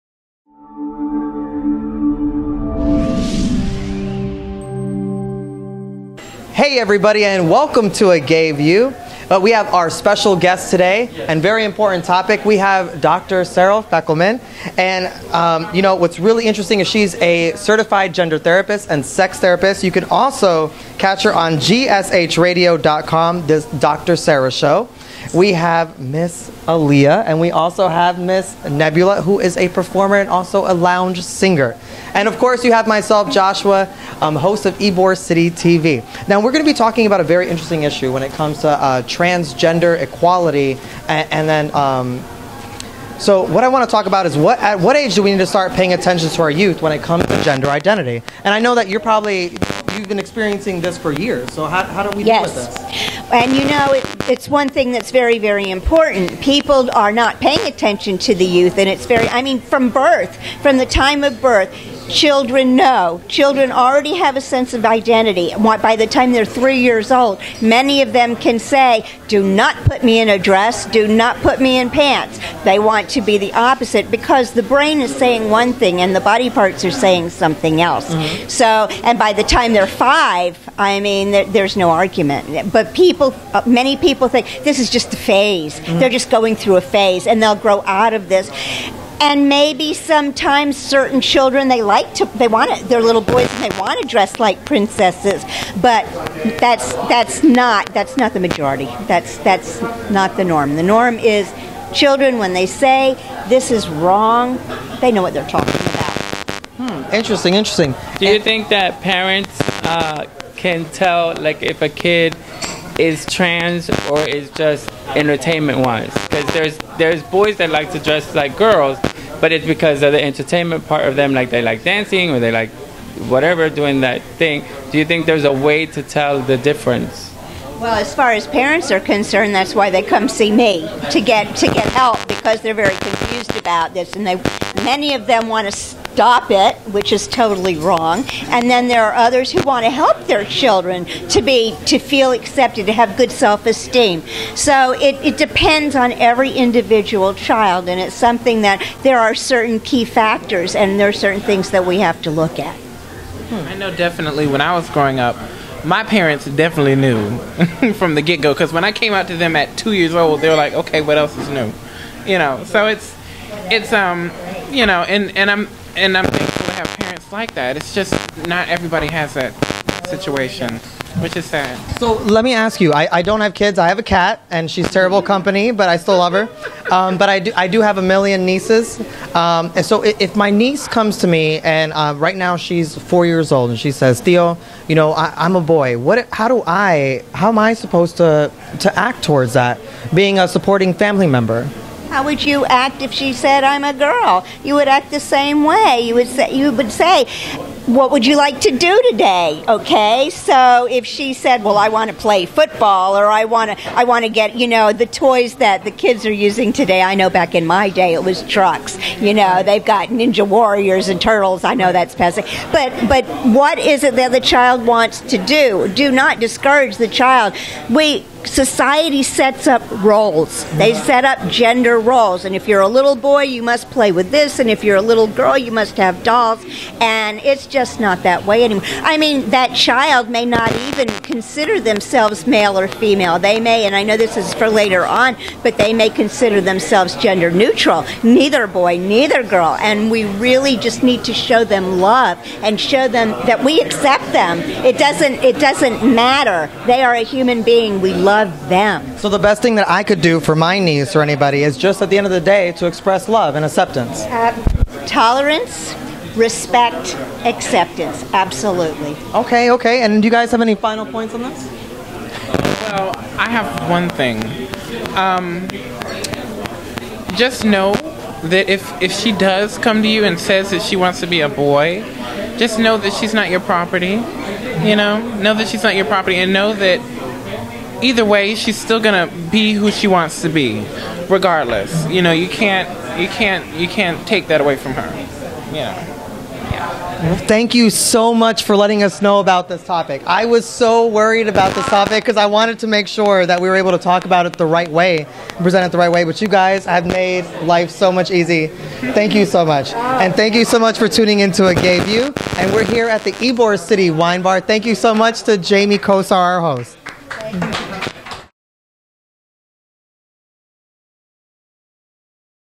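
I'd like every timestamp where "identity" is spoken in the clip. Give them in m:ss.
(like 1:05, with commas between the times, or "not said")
0:47, 1:04.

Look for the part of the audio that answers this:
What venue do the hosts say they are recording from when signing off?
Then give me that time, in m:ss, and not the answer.
5:03.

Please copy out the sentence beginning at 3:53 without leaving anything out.
They may, and I know this is for later on, but they may consider themselves gender neutral.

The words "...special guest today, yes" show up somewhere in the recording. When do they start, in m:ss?
0:09.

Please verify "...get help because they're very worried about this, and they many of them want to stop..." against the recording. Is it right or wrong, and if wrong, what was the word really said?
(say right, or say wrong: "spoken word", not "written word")
wrong: "confused", not "worried".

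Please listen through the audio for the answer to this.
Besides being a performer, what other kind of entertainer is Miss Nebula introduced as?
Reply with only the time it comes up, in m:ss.
0:30.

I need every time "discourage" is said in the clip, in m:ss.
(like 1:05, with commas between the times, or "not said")
3:36.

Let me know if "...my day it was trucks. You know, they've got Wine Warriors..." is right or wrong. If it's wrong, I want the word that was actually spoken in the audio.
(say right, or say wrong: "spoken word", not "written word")
wrong: "Ninja", not "Wine".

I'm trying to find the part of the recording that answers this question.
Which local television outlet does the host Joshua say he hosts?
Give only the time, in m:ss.
0:34.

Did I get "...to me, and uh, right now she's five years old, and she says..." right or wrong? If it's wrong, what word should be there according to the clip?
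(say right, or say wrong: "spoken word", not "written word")
wrong: "four", not "five".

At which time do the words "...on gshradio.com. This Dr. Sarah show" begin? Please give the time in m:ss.
0:21.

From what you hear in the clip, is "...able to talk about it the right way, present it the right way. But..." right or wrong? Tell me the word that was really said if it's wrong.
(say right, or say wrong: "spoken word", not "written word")
right.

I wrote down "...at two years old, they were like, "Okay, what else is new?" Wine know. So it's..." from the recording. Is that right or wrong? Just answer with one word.
wrong.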